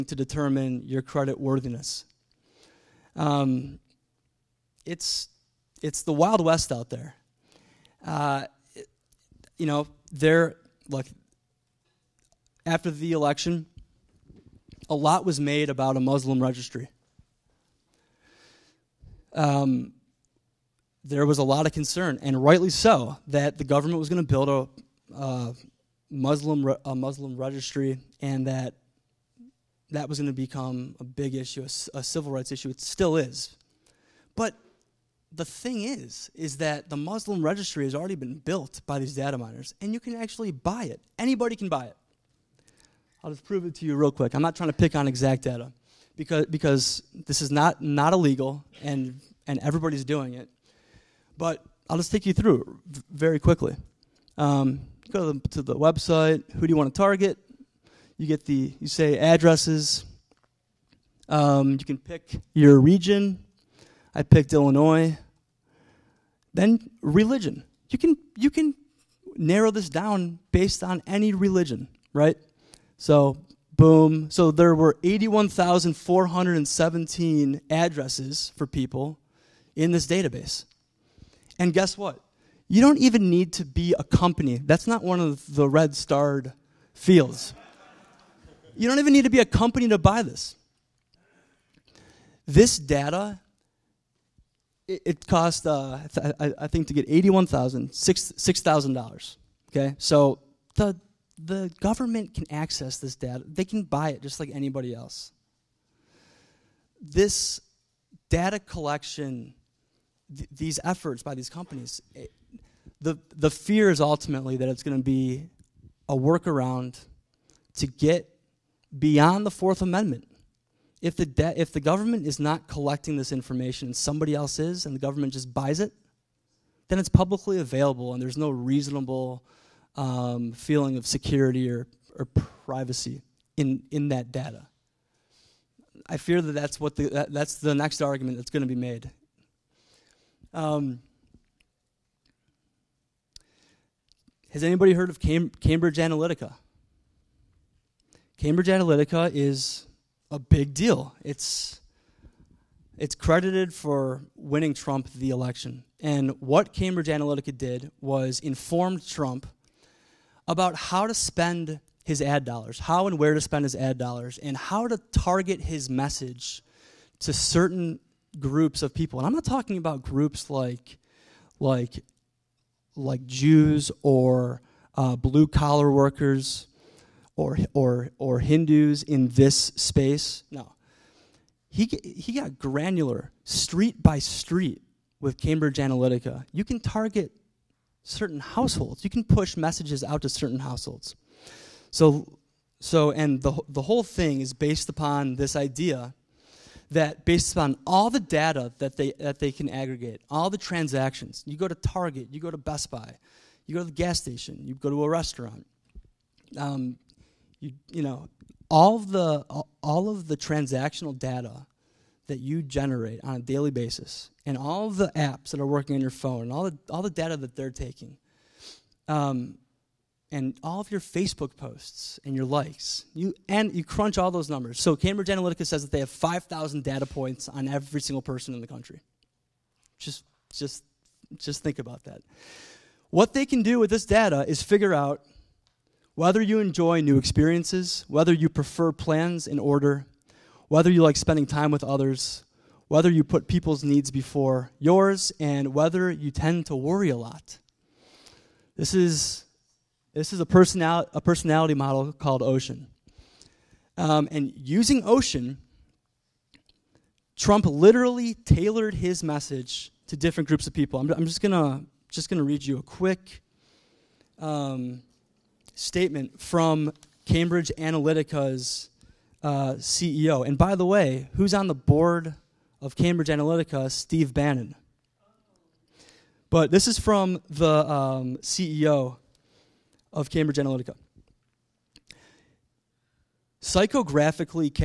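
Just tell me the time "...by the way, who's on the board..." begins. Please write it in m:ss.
4:30.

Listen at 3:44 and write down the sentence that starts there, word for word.
So Cambridge Analytica says that they have 5,000 data points on every single person in the country.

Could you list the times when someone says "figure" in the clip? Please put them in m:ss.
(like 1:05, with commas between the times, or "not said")
3:54.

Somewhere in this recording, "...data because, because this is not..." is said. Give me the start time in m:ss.
0:45.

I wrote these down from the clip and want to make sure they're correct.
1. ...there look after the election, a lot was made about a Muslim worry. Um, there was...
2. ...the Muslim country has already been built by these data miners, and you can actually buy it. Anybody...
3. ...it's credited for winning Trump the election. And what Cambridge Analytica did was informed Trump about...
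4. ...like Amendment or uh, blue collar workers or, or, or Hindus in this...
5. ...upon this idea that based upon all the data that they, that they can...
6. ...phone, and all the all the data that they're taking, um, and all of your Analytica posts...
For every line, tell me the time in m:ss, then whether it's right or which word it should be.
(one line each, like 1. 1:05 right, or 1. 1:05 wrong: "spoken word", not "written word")
1. 0:10 wrong: "registry", not "worry"
2. 0:36 wrong: "registry", not "country"
3. 2:32 right
4. 2:52 wrong: "Jews", not "Amendment"
5. 3:14 right
6. 3:36 wrong: "Facebook", not "Analytica".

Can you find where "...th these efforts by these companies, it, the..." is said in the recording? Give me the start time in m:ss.
1:50.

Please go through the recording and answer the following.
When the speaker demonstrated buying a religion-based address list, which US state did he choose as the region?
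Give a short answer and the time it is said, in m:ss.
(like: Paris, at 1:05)
Illinois, at 1:04.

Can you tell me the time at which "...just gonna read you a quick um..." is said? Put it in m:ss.
4:22.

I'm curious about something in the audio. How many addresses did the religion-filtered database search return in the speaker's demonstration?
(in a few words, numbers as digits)
81,417.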